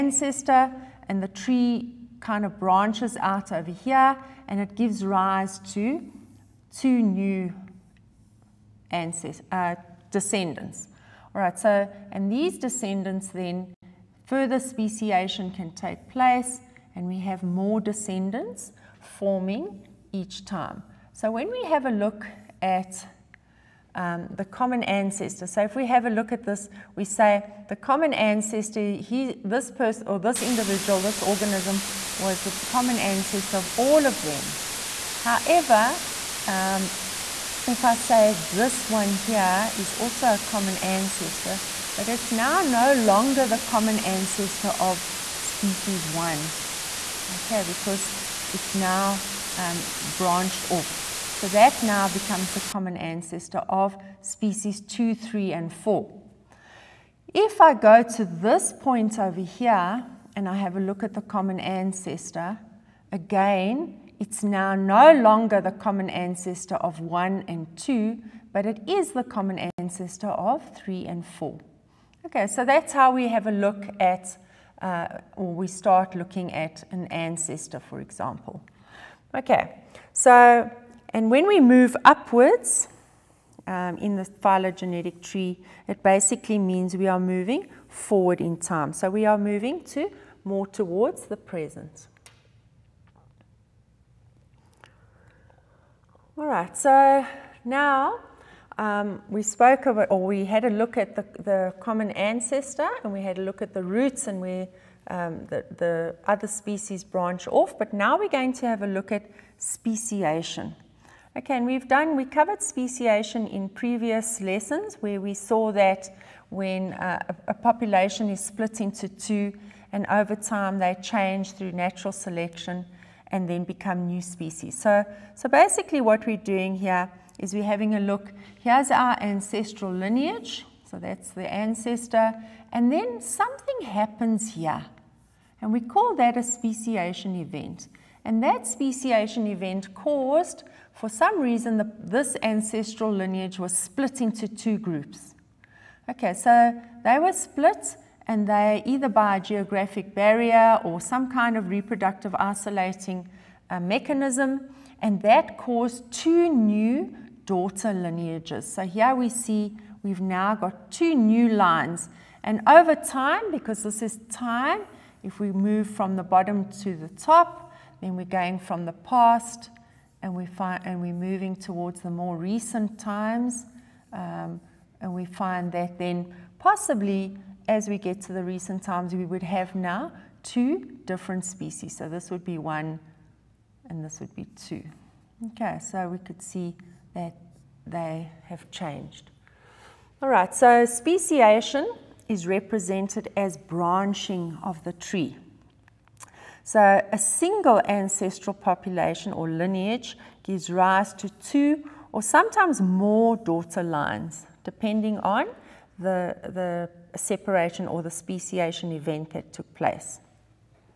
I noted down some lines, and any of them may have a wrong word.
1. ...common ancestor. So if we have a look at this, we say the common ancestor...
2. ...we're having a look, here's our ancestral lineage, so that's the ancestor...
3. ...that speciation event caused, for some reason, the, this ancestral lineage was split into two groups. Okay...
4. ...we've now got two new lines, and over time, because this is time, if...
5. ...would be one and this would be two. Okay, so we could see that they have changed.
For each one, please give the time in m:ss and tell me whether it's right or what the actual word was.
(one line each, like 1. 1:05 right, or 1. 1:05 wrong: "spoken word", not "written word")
1. 0:24 right
2. 2:07 right
3. 2:18 right
4. 2:40 right
5. 3:02 right.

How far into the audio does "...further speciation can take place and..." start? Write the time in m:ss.
0:14.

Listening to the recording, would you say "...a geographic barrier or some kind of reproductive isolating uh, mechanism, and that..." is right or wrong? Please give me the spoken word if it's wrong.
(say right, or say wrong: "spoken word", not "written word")
right.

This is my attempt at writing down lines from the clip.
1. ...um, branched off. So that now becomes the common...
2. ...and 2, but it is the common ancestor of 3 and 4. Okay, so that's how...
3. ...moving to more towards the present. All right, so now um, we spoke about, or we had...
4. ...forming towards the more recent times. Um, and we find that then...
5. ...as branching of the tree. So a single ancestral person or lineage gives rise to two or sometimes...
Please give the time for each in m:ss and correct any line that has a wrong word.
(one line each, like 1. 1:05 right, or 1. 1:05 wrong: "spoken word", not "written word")
1. 0:49 right
2. 1:07 right
3. 1:29 right
4. 2:51 wrong: "moving", not "forming"
5. 3:13 wrong: "population", not "person".